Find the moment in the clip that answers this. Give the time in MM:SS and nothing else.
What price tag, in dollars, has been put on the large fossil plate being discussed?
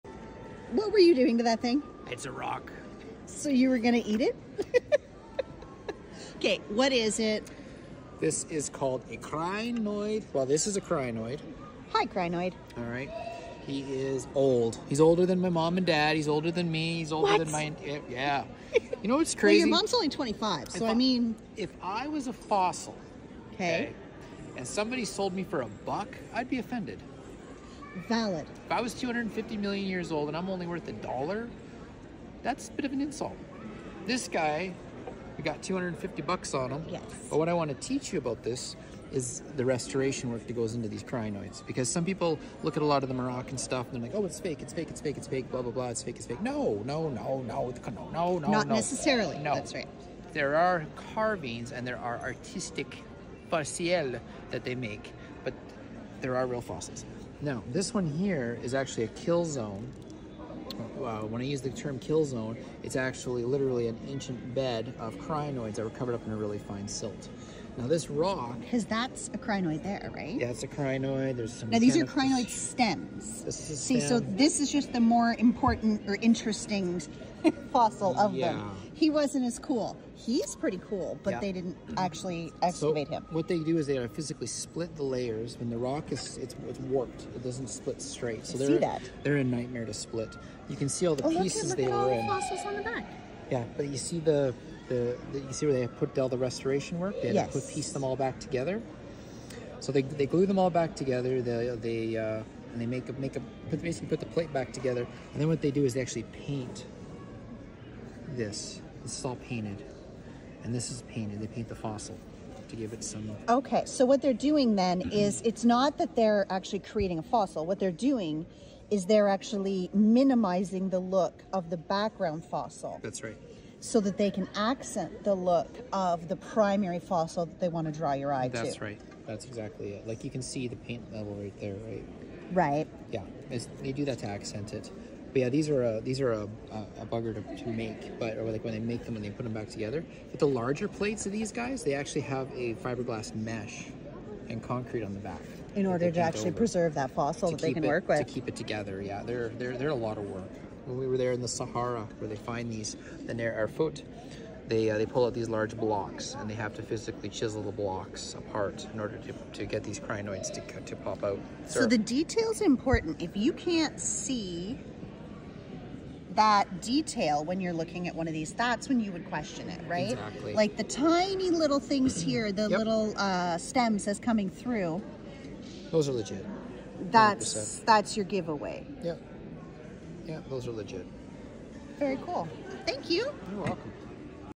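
00:35.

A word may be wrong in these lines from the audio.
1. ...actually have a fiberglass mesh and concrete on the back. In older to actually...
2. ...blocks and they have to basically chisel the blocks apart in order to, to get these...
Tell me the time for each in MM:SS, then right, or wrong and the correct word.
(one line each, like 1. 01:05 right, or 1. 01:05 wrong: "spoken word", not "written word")
1. 02:21 wrong: "order", not "older"
2. 02:35 wrong: "physically", not "basically".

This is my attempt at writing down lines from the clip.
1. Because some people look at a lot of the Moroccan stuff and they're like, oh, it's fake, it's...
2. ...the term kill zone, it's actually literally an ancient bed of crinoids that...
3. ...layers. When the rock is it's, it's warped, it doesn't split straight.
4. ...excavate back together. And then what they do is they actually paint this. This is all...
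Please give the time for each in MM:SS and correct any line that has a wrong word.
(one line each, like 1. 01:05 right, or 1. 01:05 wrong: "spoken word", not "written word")
1. 00:41 right
2. 01:01 right
3. 01:25 right
4. 01:44 wrong: "plate", not "excavate".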